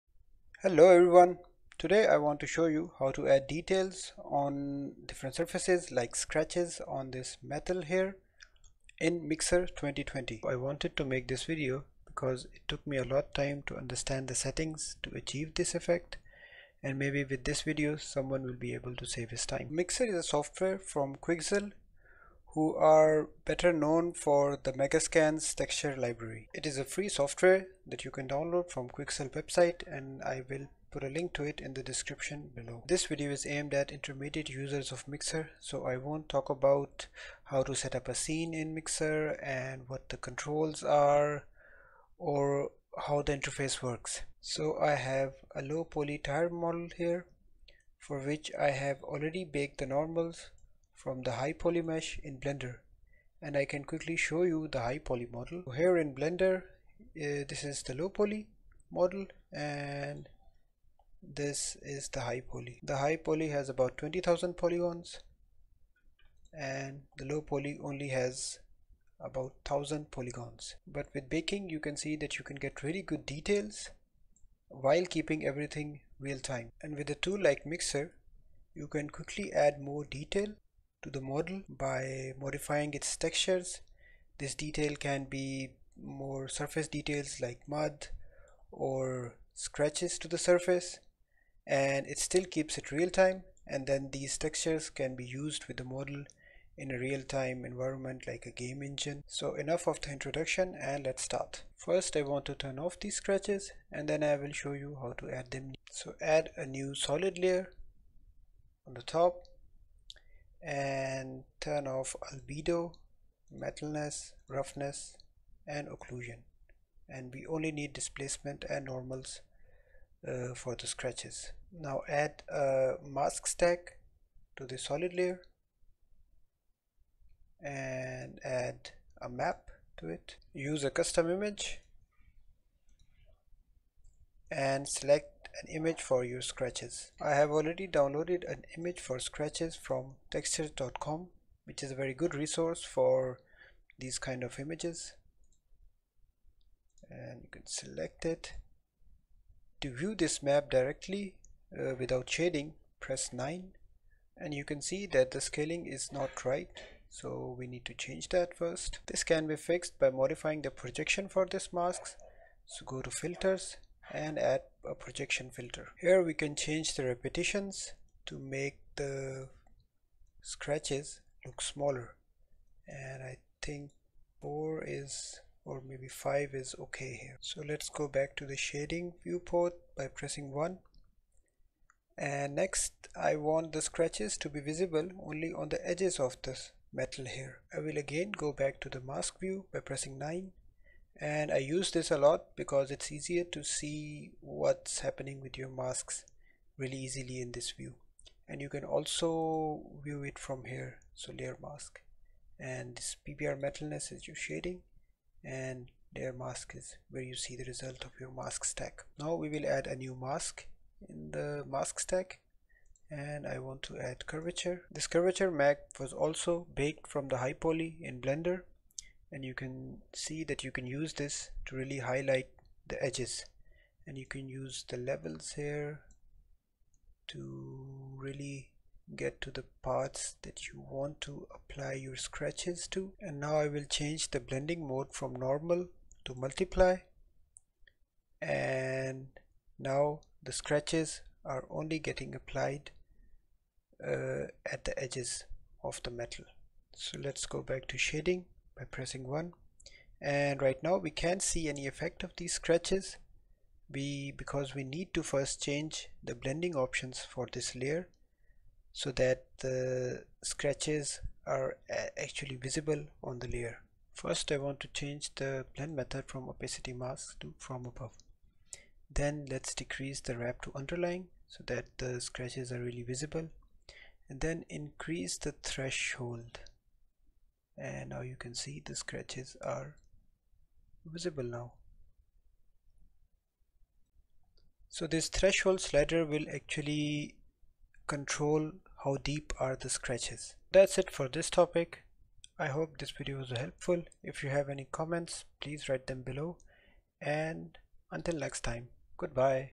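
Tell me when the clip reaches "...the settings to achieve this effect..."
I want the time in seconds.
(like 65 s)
14 s.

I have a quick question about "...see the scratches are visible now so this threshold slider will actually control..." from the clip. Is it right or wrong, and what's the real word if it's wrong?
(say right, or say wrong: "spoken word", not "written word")
right.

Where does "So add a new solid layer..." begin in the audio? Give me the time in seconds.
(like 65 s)
105 s.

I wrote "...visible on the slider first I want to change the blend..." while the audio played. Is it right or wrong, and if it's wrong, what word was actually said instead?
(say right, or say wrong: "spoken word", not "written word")
wrong: "layer", not "slider".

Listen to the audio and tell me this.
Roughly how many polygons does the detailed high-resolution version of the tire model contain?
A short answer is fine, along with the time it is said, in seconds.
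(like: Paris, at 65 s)
20,000, at 63 s.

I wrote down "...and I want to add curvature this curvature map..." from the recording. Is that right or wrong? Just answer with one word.
right.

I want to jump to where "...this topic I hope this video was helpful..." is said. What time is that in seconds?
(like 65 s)
291 s.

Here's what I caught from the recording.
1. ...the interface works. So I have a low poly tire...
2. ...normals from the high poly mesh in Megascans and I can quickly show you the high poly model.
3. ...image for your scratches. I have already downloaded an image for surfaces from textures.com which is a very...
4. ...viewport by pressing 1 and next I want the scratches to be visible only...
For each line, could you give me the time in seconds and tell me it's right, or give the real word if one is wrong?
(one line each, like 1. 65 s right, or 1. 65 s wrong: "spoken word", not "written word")
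1. 43 s right
2. 49 s wrong: "Blender", not "Megascans"
3. 135 s wrong: "scratches", not "surfaces"
4. 179 s right.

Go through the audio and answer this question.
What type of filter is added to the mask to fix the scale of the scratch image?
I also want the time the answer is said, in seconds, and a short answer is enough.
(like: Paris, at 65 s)
projection filter, at 164 s.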